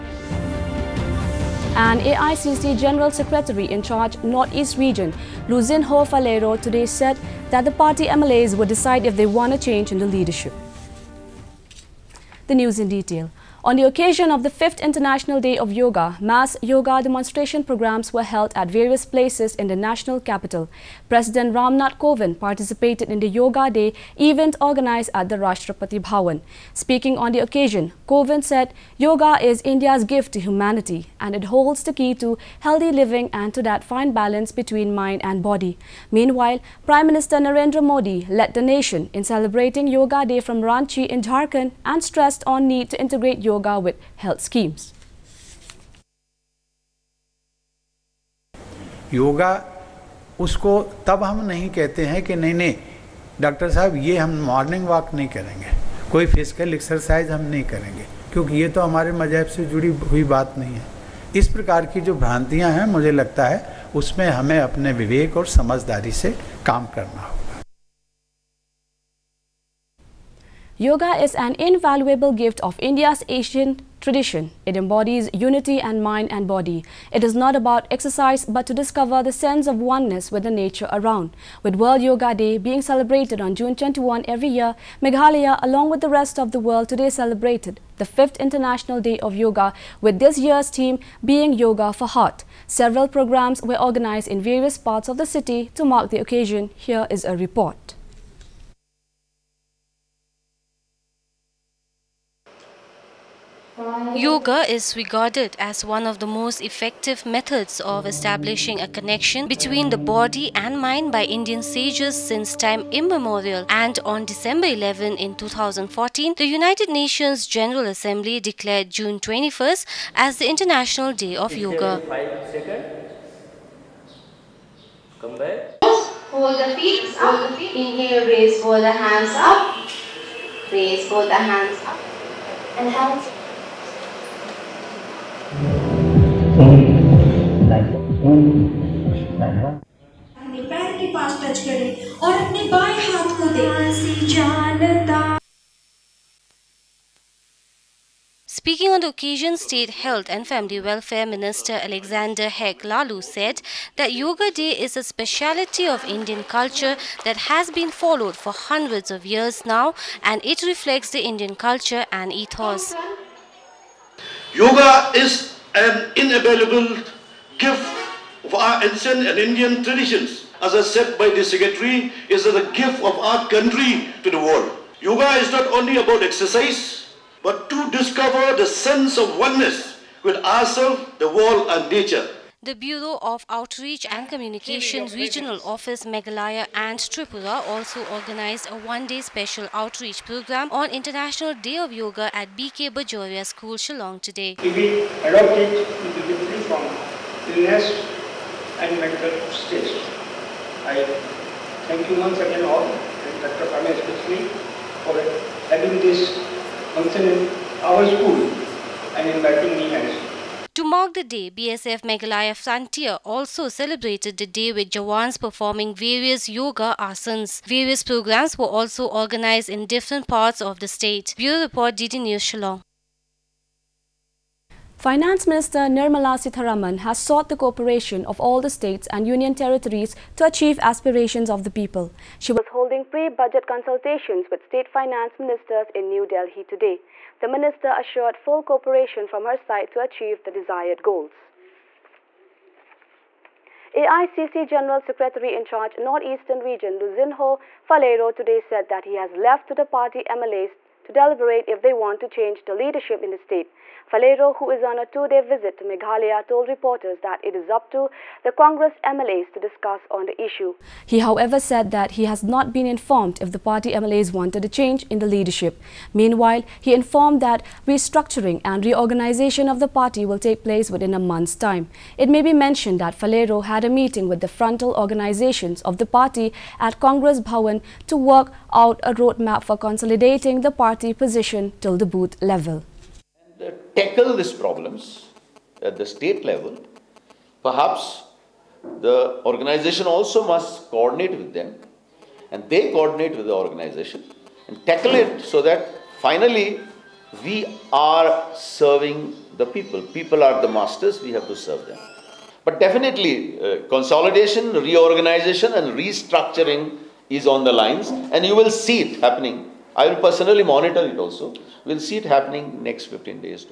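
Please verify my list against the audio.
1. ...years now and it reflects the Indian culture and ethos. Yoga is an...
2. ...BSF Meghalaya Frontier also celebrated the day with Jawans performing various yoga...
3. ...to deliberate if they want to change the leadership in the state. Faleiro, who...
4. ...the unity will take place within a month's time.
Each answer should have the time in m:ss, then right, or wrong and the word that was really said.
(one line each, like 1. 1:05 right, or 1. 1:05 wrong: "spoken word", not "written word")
1. 2:39 right
2. 3:31 right
3. 4:11 right
4. 4:29 wrong: "party", not "unity".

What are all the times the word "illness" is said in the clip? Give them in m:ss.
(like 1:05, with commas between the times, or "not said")
3:17.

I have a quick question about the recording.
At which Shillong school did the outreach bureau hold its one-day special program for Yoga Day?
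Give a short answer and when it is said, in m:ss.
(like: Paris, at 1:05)
BK Bajoria School, at 3:12.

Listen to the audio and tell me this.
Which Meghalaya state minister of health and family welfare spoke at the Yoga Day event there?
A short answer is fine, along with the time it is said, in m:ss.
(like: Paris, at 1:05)
Alexander Hek Laloo, at 2:31.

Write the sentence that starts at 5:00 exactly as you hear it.
People are the masters, we have to serve them.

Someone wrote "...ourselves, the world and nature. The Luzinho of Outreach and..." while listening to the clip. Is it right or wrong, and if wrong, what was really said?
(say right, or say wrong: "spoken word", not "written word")
wrong: "Bureau", not "Luzinho".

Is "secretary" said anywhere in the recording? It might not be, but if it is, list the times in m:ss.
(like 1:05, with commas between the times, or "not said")
0:03, 2:51, 4:05.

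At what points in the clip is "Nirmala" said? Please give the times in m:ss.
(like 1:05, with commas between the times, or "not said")
3:45.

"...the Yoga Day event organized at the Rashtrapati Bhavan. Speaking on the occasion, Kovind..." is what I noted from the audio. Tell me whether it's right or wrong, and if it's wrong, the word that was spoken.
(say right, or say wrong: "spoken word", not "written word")
right.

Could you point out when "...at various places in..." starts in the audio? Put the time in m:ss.
0:18.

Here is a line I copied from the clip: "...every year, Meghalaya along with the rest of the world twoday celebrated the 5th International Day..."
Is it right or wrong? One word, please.
wrong.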